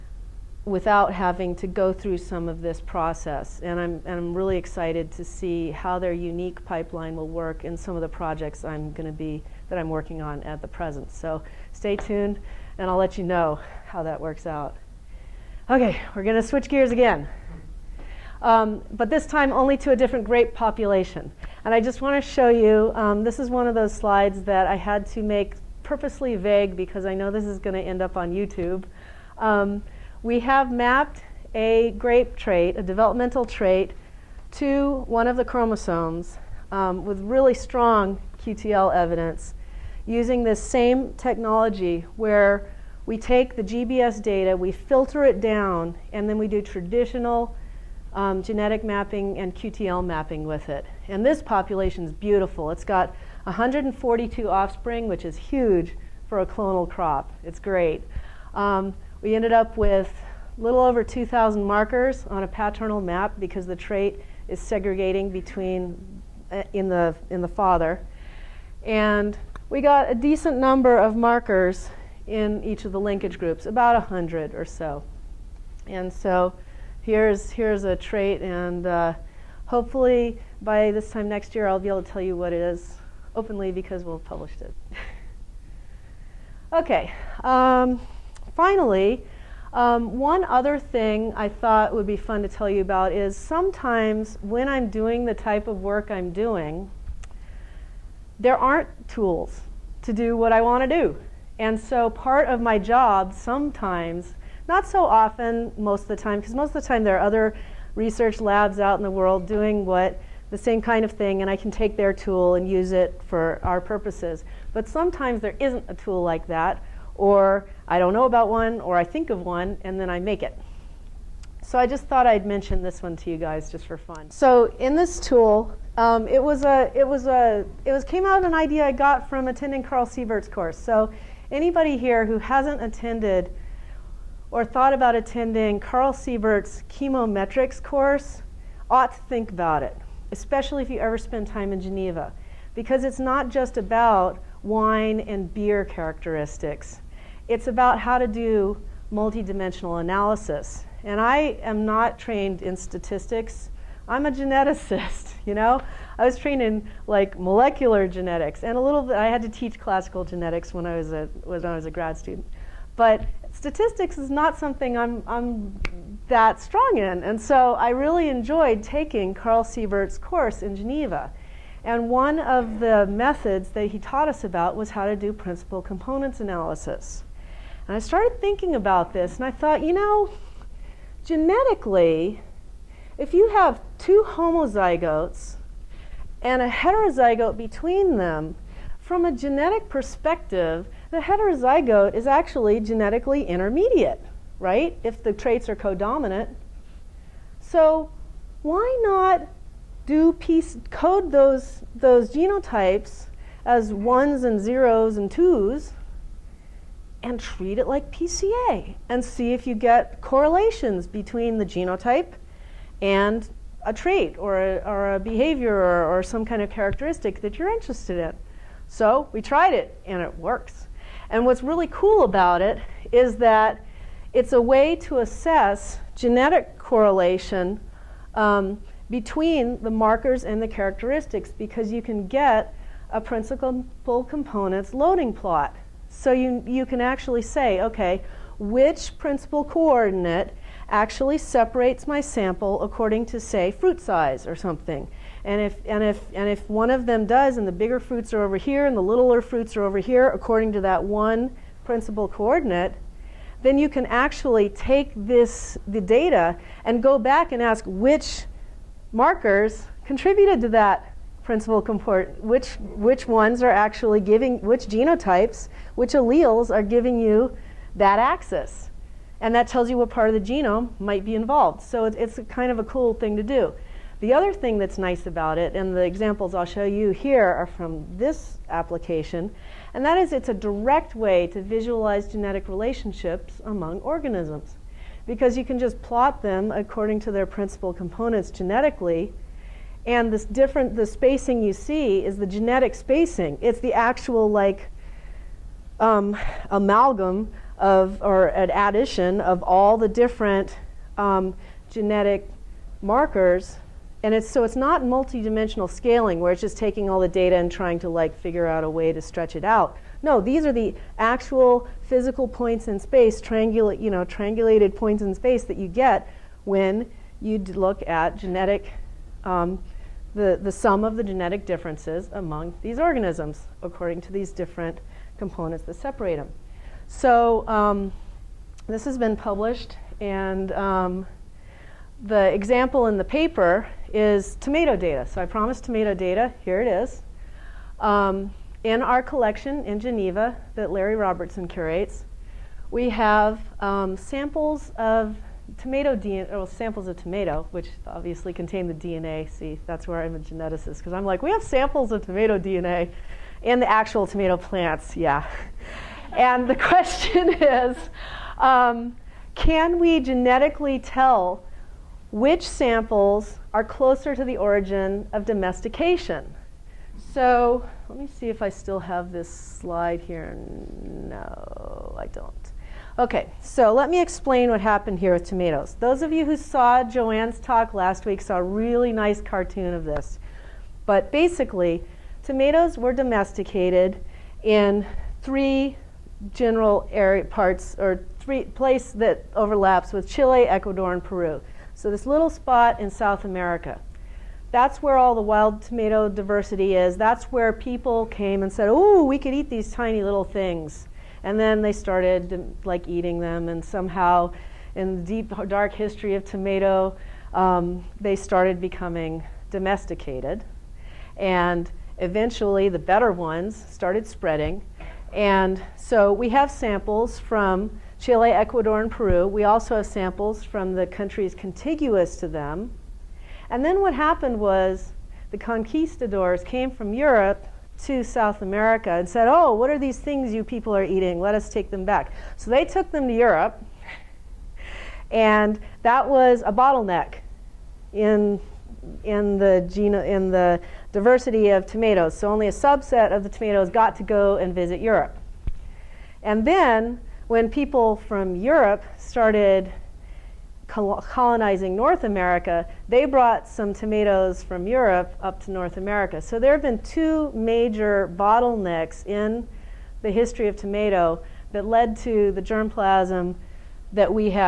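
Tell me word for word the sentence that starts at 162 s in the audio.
But statistics is not something I'm I'm that strong in.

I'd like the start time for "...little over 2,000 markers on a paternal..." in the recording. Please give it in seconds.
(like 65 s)
60 s.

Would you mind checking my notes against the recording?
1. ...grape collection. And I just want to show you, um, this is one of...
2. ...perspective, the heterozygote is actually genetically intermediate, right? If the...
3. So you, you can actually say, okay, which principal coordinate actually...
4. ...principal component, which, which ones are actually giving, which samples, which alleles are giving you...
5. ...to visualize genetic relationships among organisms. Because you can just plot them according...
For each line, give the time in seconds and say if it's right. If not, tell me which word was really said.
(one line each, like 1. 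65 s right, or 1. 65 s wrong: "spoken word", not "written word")
1. 20 s wrong: "population", not "collection"
2. 189 s right
3. 236 s right
4. 261 s wrong: "genotypes", not "samples"
5. 281 s right.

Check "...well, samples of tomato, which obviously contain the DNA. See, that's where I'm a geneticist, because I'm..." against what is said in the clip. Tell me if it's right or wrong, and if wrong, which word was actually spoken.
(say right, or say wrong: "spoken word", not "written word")
right.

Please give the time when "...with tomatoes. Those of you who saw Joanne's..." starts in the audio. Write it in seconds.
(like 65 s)
375 s.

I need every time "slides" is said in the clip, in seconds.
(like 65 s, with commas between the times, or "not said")
23 s, 369 s.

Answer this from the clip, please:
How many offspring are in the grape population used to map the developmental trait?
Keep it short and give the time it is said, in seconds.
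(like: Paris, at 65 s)
142, at 53 s.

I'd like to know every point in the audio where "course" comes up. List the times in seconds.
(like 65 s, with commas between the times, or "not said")
130 s, 137 s, 170 s.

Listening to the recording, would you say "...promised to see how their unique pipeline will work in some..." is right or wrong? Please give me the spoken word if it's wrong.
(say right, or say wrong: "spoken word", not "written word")
wrong: "excited", not "promised".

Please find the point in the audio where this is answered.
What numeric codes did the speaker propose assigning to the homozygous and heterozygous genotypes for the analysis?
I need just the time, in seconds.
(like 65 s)
203 s.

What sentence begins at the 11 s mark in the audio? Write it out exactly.
So stay tuned, and I'll let you know how that works out.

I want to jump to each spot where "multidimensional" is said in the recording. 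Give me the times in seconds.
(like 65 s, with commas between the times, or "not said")
149 s, 305 s.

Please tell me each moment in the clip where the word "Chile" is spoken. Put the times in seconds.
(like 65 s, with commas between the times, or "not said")
390 s, 418 s.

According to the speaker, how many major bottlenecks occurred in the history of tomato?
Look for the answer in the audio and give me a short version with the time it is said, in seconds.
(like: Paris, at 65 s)
2, at 456 s.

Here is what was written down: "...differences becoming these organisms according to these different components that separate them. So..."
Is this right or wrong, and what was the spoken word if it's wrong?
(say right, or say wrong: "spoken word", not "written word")
wrong: "among", not "becoming".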